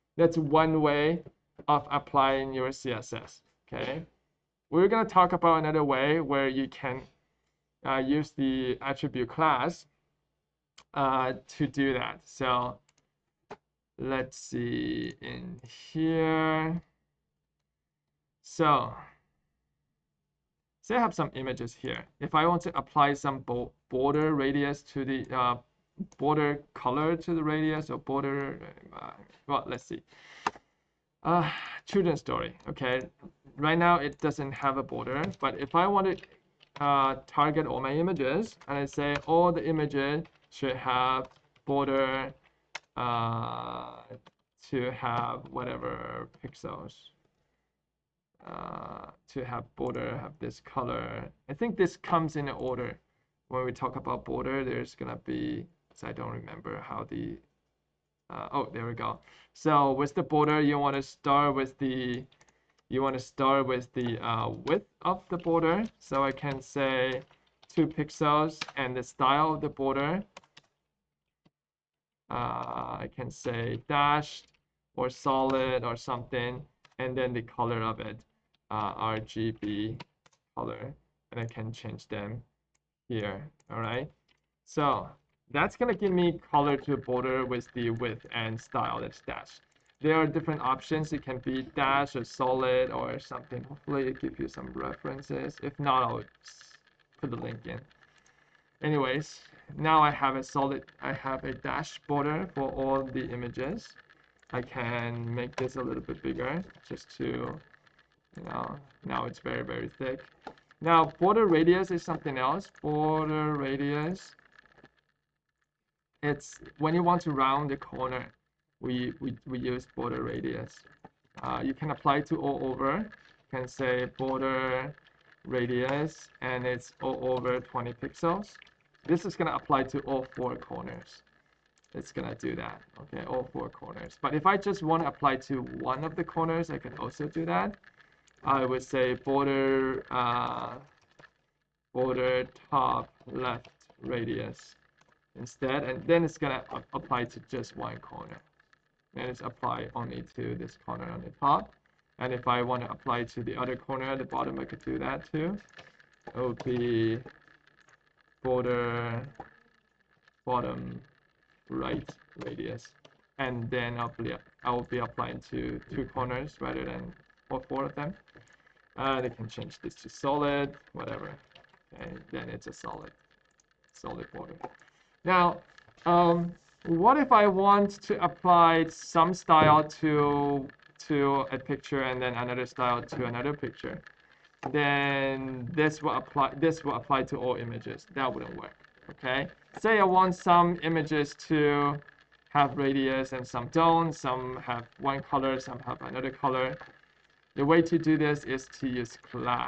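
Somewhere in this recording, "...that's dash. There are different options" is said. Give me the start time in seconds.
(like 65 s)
88 s.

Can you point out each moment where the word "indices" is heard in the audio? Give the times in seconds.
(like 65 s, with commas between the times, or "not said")
not said.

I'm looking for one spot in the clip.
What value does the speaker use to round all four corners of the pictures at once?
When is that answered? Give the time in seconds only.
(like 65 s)
127 s.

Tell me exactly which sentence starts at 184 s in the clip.
Then this will apply this will apply to all images.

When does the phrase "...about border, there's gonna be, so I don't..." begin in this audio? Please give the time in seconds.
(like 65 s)
53 s.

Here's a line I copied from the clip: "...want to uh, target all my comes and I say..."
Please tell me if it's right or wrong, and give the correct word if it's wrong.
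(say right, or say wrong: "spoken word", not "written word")
wrong: "images", not "comes".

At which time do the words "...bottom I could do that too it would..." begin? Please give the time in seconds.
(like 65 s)
154 s.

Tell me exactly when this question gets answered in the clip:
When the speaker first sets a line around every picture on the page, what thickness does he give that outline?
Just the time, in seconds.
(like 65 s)
67 s.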